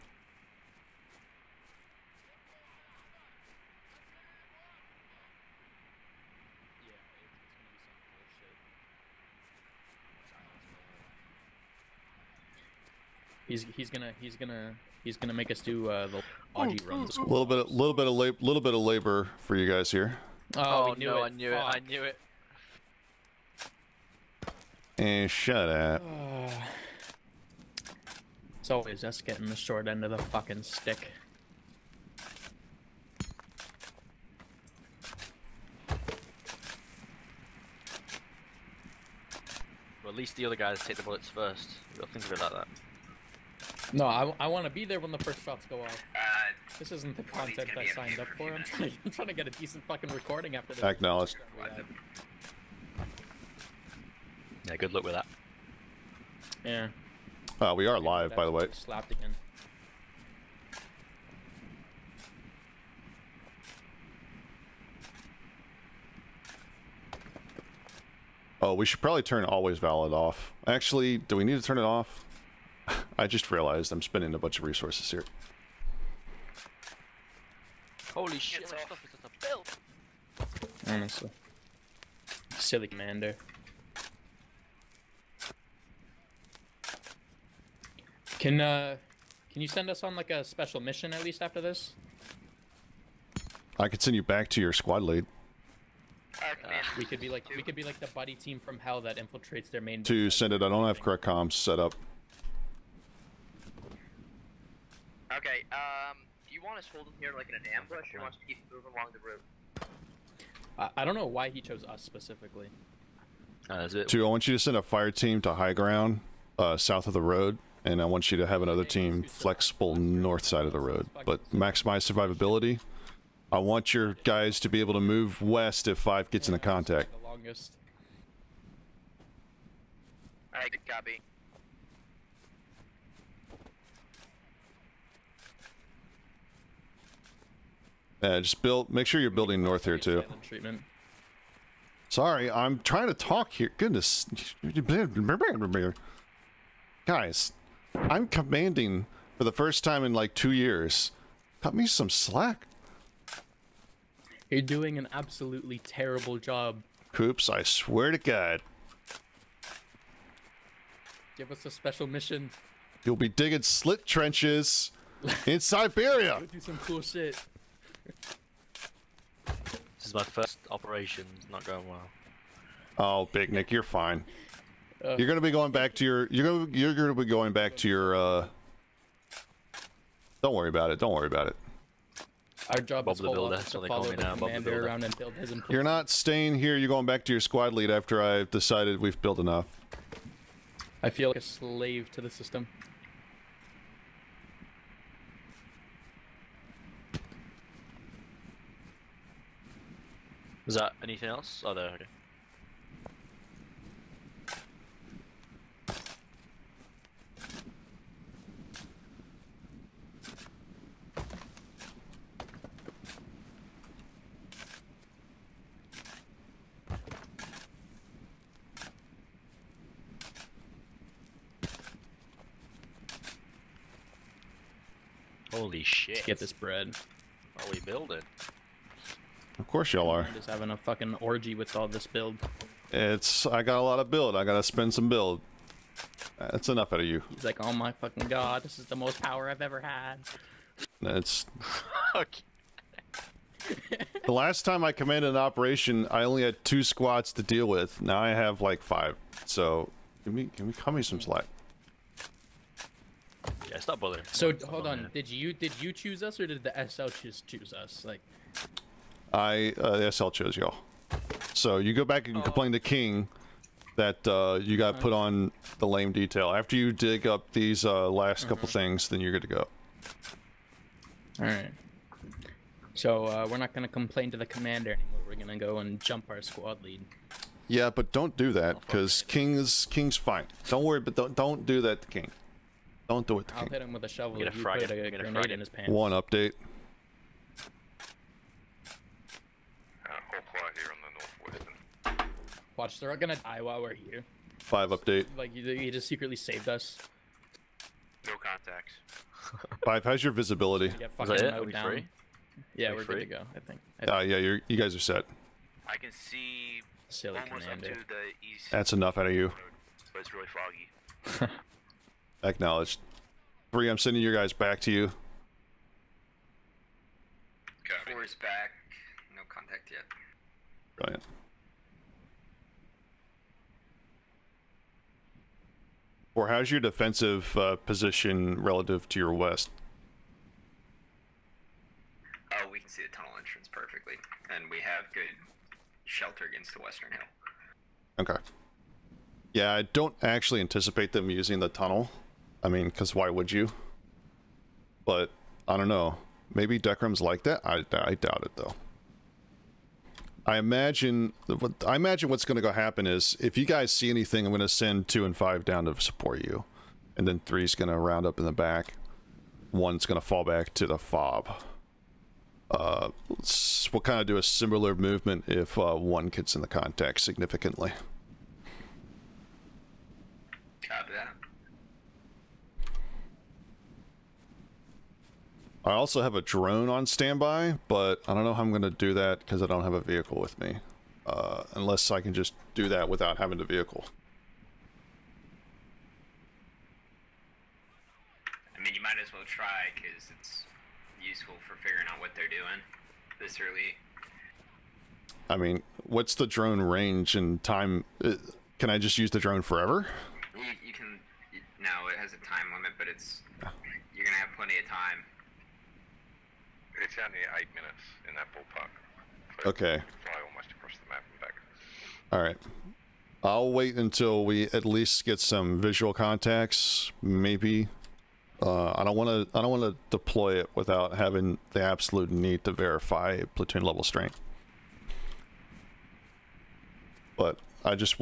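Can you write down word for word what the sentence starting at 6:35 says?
I mean, what's the drone range and time?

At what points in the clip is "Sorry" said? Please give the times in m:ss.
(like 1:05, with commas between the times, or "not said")
2:22.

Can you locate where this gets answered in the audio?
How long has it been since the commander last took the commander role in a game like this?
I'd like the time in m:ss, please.
2:30.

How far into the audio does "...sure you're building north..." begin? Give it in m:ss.
2:19.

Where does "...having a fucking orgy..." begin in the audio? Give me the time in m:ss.
3:50.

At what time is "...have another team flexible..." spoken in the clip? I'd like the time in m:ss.
1:58.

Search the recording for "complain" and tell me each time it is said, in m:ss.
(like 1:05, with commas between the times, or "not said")
4:22, 4:33.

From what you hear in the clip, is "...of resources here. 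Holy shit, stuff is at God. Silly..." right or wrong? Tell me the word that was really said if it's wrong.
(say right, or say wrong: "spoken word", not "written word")
wrong: "Honestly", not "God".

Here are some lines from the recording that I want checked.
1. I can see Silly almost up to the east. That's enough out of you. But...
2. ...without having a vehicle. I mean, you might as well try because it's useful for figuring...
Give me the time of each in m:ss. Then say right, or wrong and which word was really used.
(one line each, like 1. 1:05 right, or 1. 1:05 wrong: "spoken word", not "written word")
1. 5:05 right
2. 6:23 right.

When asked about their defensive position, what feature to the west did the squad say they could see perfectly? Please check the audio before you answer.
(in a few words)
The tunnel entrance.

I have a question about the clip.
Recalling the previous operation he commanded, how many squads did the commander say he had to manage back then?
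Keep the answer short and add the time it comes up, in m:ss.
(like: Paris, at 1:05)
2, at 4:06.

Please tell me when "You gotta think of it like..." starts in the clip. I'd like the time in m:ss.
0:41.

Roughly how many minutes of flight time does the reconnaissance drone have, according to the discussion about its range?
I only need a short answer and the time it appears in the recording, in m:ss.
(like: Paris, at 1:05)
8 minutes, at 6:47.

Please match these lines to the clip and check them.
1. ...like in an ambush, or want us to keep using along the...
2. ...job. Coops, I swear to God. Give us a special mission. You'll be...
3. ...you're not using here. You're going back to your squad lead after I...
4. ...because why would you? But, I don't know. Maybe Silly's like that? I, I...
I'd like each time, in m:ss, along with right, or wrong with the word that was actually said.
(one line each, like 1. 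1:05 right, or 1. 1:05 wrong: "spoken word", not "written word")
1. 1:47 wrong: "moving", not "using"
2. 2:36 right
3. 3:05 wrong: "staying", not "using"
4. 5:42 wrong: "Decrum", not "Silly".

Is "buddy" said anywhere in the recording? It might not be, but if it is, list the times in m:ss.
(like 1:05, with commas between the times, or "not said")
1:38.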